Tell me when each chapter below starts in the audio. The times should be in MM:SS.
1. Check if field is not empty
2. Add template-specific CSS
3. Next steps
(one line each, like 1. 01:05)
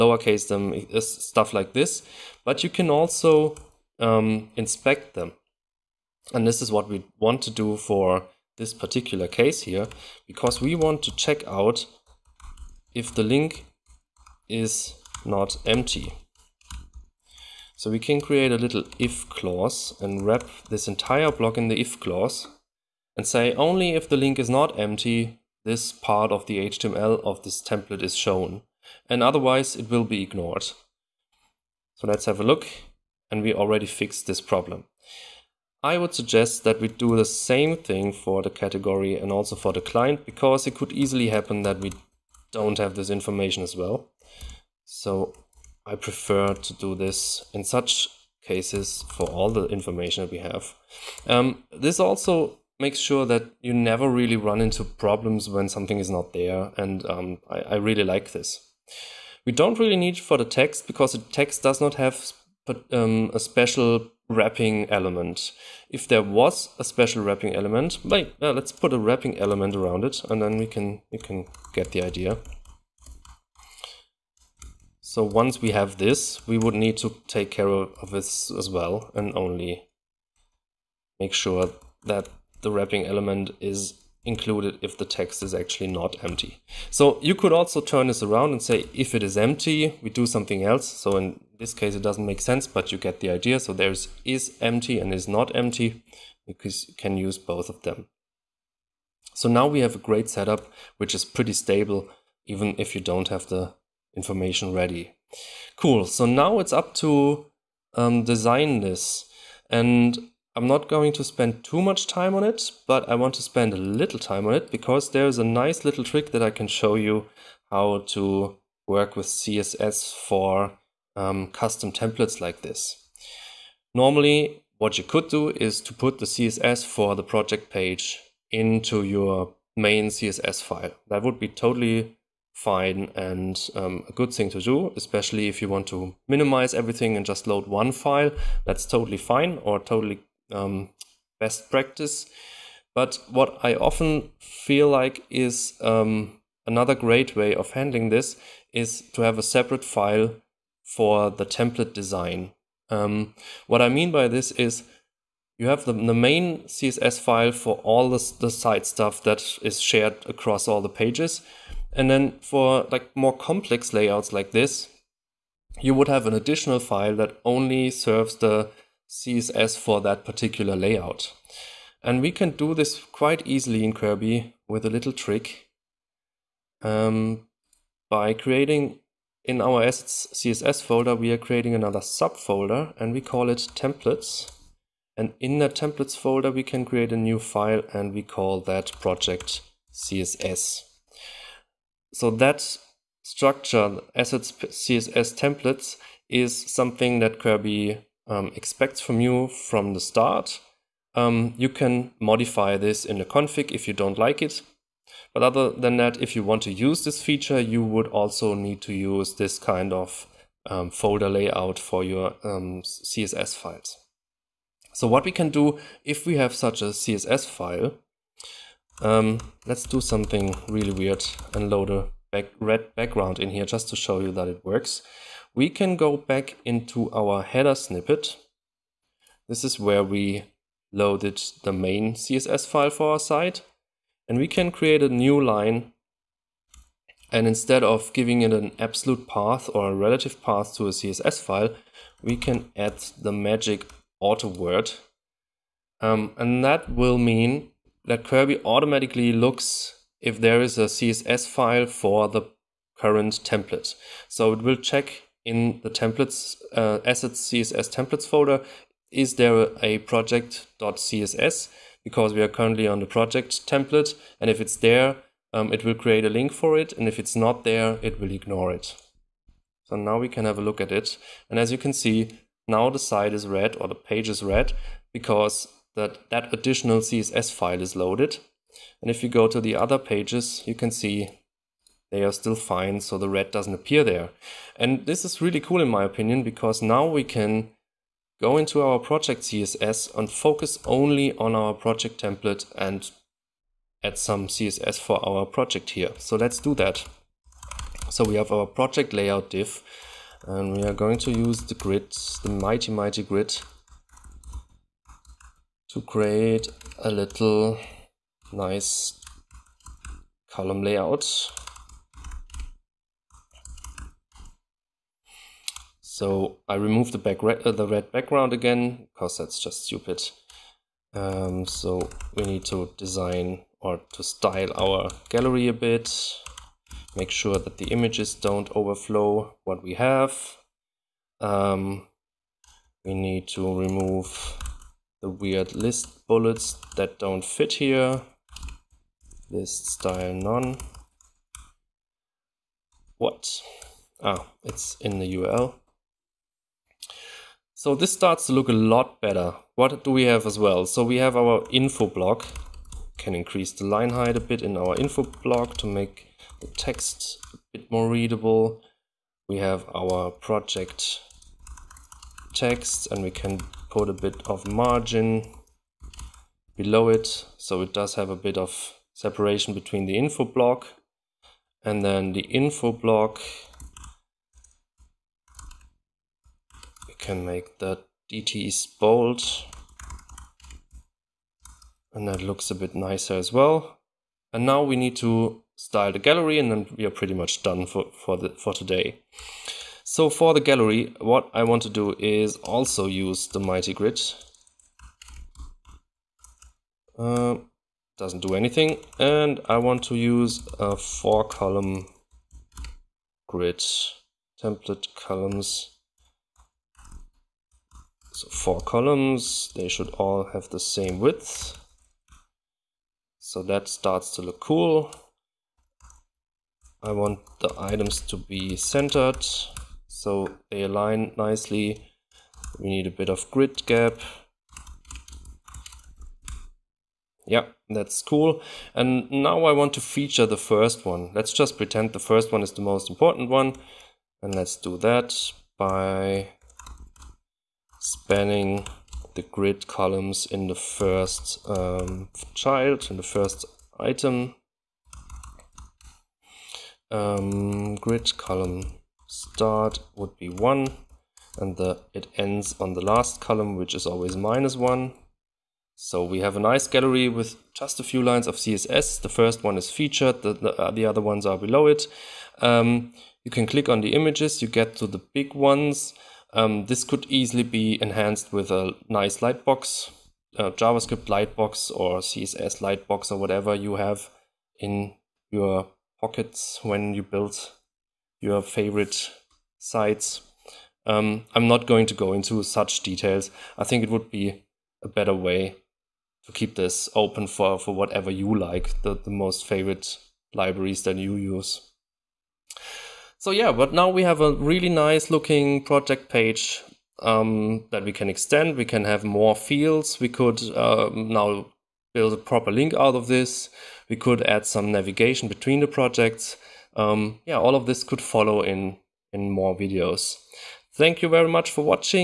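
1. 00:05
2. 01:45
3. 08:11.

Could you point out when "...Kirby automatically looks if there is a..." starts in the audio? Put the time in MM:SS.
04:08.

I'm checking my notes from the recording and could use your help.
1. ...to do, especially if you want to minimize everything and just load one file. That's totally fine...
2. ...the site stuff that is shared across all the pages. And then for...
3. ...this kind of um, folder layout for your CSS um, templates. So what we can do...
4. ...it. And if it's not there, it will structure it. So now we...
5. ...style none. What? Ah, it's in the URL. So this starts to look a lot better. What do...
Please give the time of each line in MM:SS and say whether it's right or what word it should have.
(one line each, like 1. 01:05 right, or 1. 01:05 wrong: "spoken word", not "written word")
1. 02:14 right
2. 02:38 right
3. 03:29 wrong: "files", not "templates"
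4. 04:26 wrong: "ignore", not "structure"
5. 05:39 right.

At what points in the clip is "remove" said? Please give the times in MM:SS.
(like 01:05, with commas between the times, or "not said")
05:16, 05:33.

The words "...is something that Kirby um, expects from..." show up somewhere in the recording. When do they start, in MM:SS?
03:16.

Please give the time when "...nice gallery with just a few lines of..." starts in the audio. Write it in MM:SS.
07:36.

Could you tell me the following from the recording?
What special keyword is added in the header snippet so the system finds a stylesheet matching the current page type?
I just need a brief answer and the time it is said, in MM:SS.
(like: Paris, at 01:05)
auto, at 04:04.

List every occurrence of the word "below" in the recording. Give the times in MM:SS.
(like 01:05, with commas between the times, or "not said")
06:06, 07:41.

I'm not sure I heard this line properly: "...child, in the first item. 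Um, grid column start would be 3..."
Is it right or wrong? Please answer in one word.
wrong.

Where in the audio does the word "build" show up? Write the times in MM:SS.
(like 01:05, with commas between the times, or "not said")
07:57, 08:22.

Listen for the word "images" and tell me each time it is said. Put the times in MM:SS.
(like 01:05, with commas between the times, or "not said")
05:27, 07:44.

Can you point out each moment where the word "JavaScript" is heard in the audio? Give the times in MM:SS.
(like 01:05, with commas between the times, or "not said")
07:50.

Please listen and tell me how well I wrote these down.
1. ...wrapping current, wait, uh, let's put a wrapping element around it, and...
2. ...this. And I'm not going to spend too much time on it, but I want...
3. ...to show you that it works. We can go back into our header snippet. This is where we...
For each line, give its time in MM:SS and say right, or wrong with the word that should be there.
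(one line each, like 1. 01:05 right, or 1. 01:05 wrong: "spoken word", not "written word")
1. 01:07 wrong: "element", not "current"
2. 01:48 right
3. 03:43 right.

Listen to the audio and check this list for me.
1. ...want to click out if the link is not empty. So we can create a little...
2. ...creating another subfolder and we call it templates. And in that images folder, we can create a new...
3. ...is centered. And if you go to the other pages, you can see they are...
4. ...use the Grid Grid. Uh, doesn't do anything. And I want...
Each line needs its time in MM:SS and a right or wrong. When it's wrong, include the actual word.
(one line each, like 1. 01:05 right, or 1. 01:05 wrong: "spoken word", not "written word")
1. 00:10 wrong: "check", not "click"
2. 03:01 wrong: "templates", not "images"
3. 04:37 wrong: "loaded", not "centered"
4. 06:33 wrong: "Mighty", not "Grid".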